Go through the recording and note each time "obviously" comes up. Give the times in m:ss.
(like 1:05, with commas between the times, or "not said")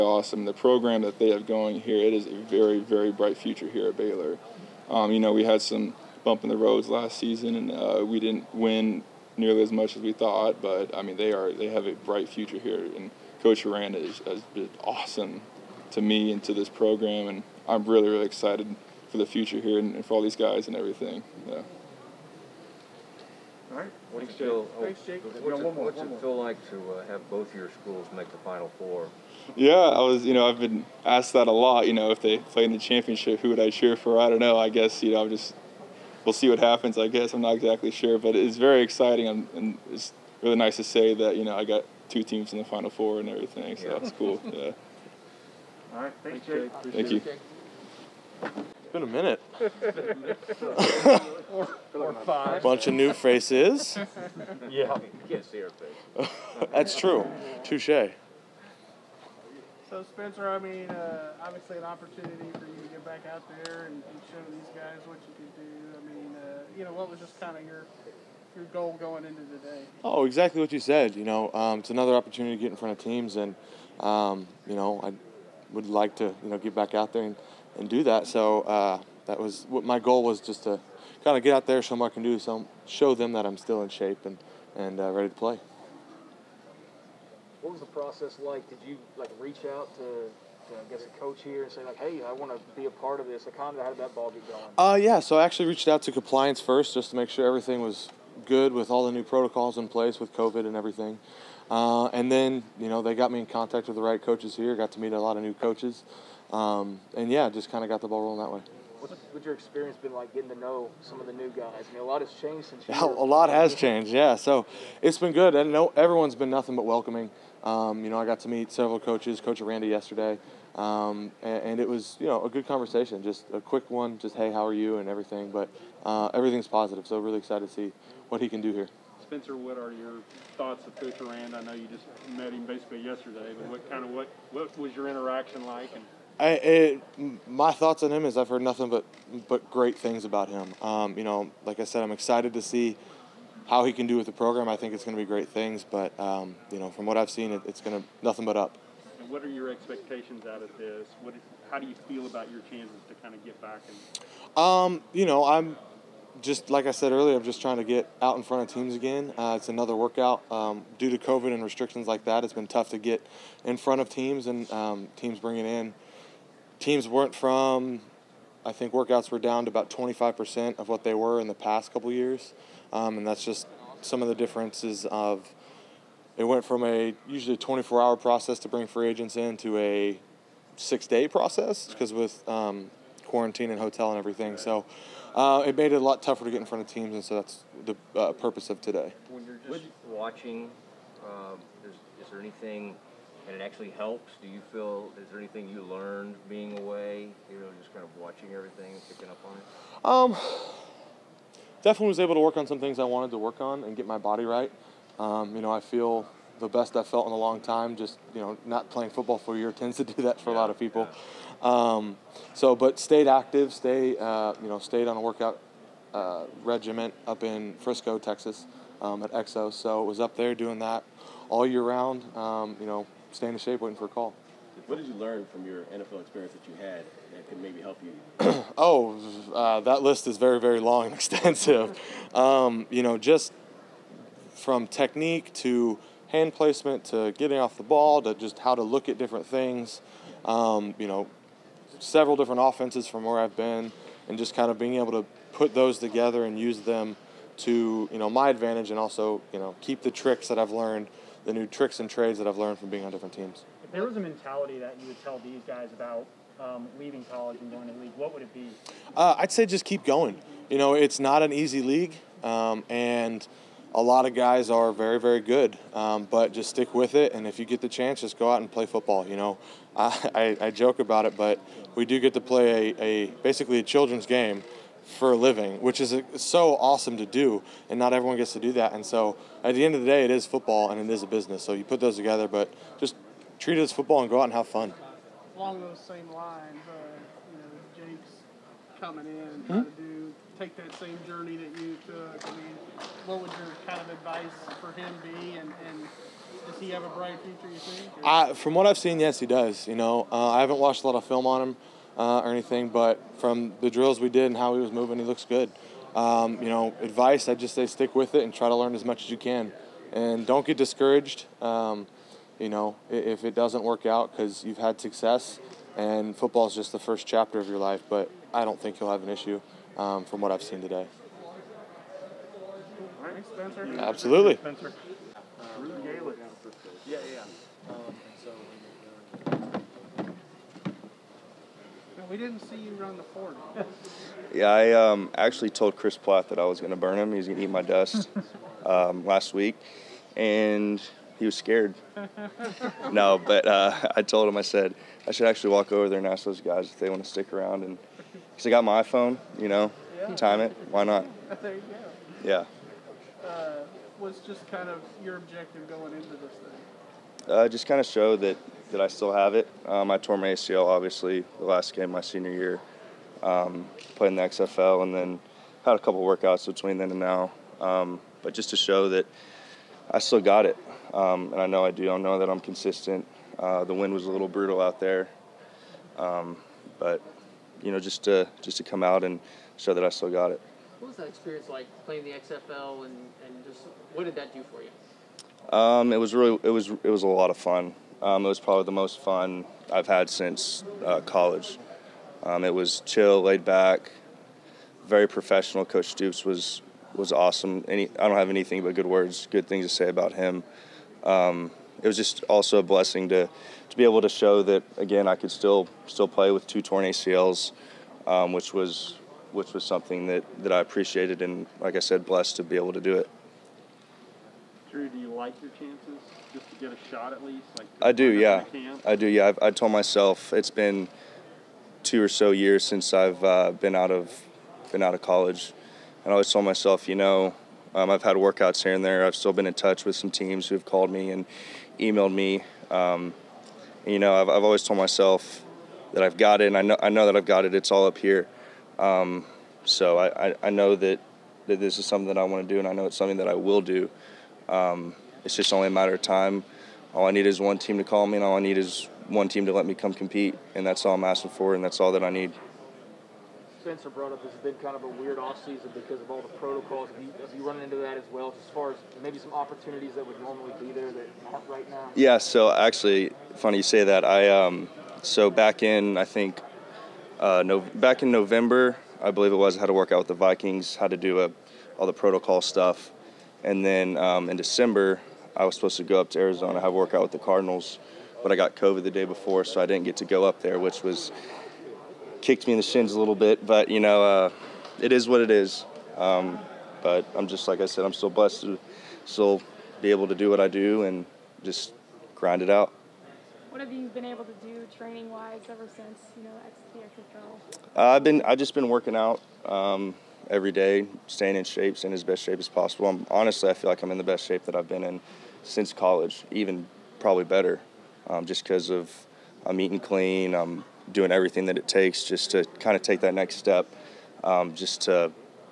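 1:01, 6:00.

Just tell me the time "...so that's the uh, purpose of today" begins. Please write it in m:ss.
3:07.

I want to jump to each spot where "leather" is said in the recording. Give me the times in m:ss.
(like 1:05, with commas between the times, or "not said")
not said.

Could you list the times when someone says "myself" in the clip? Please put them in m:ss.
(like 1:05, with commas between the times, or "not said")
6:59, 7:06, 7:14.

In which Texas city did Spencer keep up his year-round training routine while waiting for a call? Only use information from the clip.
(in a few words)
Frisco.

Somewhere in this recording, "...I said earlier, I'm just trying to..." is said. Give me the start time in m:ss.
2:36.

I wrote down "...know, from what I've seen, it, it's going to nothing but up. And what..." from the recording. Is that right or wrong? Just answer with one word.
right.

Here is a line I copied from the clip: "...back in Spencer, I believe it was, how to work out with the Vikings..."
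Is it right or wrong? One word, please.
wrong.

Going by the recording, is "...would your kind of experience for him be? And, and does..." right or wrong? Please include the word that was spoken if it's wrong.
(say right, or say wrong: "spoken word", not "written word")
wrong: "advice", not "experience".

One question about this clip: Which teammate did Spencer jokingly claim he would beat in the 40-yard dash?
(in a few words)
Chris Platt.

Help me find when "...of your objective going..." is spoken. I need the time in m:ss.
5:54.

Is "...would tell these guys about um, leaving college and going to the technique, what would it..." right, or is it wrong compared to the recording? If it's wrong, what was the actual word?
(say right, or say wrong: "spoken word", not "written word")
wrong: "league", not "technique".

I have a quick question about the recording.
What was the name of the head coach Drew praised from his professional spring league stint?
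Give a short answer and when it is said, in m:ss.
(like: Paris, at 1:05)
Coach Stoops, at 6:35.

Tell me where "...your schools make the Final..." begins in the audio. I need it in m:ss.
0:27.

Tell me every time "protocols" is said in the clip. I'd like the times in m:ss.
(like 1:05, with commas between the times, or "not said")
1:39, 7:36, 7:52.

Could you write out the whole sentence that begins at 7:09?
I've still been in touch with some teams who've called me and emailed me.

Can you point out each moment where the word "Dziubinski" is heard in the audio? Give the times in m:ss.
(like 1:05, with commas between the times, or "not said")
not said.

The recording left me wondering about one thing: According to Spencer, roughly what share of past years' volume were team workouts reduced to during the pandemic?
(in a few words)
25%.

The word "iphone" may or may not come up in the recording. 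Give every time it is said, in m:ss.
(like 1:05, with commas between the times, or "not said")
5:49.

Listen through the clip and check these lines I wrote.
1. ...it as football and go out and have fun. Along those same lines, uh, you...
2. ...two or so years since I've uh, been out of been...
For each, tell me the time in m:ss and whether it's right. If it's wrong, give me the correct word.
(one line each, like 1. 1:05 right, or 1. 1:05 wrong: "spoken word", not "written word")
1. 4:43 right
2. 7:02 right.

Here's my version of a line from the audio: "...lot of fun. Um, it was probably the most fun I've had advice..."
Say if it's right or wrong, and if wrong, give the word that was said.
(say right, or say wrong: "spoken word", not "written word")
wrong: "since", not "advice".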